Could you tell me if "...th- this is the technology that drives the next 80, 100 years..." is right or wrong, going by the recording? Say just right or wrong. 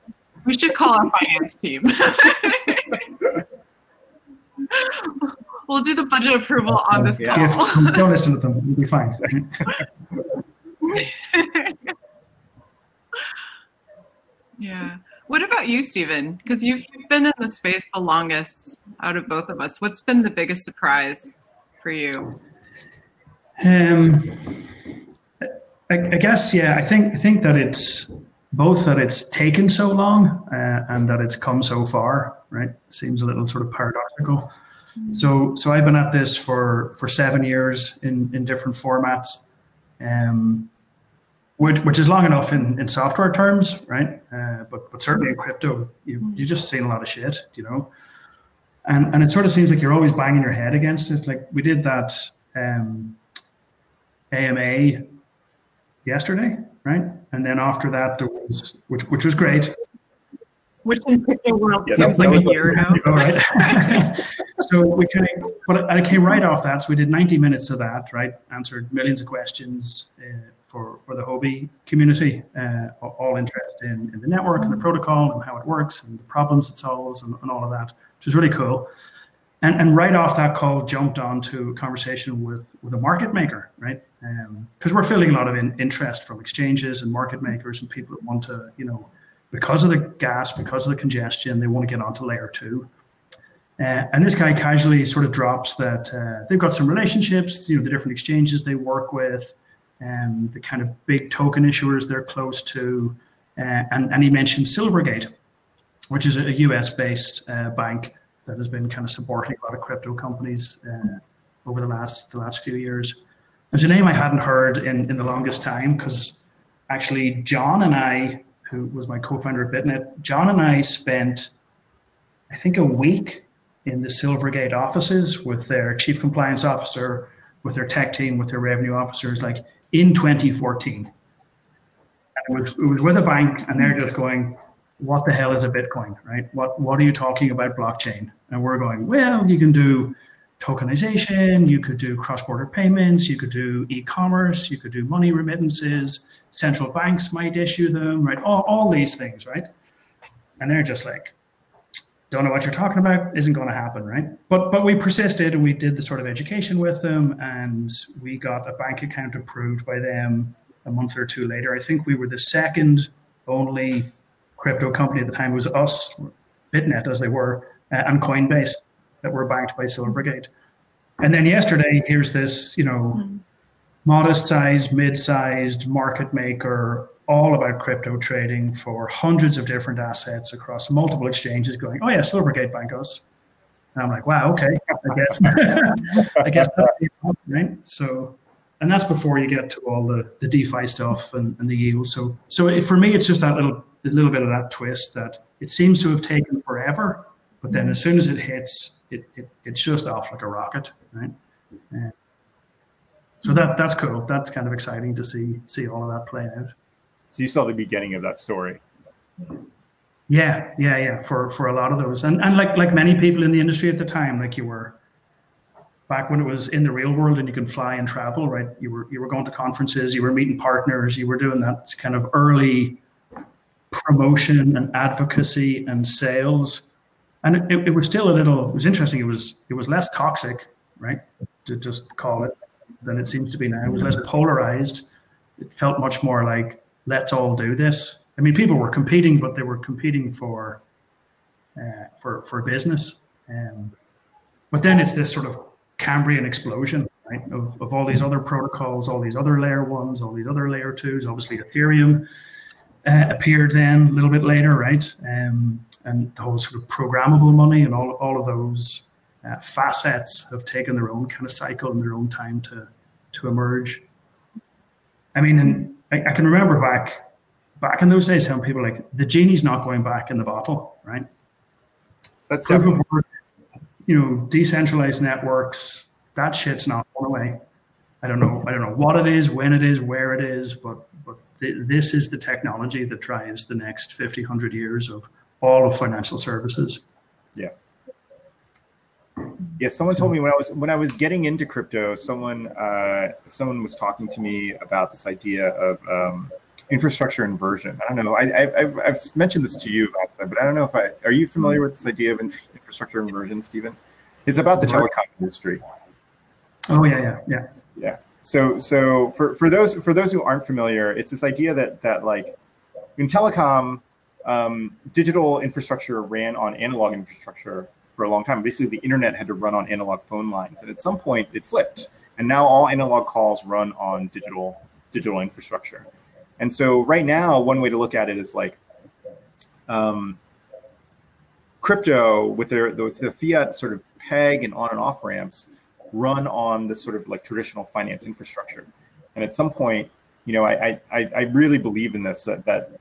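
wrong.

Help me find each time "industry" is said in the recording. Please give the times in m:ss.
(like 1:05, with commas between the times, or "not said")
3:33, 5:05.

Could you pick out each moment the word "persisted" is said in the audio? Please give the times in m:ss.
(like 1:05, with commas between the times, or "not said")
2:34.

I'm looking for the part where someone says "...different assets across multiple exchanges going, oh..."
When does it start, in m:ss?
2:59.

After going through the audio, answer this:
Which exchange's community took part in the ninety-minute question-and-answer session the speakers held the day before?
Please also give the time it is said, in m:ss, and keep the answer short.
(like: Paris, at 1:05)
Huobi, at 1:11.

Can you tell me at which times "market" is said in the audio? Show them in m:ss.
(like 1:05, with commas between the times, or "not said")
1:22, 1:27, 2:55.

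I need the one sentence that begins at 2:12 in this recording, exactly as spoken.
And it was, it was with a bank, and they're just going, What the hell is a Bitcoin, right?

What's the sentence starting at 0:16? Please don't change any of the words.
Because you've been in the space the longest out of both of us.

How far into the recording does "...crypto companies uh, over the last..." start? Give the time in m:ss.
1:49.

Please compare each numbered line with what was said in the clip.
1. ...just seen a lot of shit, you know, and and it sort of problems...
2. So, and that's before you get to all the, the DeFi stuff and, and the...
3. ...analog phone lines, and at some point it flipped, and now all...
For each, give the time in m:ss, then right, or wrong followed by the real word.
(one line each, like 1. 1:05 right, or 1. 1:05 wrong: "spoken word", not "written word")
1. 0:46 wrong: "seems", not "problems"
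2. 3:07 right
3. 5:19 right.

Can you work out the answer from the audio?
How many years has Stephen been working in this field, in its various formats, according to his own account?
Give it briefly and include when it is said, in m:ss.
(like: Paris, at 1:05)
7, at 0:37.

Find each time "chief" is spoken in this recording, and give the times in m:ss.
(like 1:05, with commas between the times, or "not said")
2:05.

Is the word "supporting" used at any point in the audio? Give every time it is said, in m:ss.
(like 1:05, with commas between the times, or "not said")
1:49.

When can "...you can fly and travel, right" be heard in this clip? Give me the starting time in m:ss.
3:37.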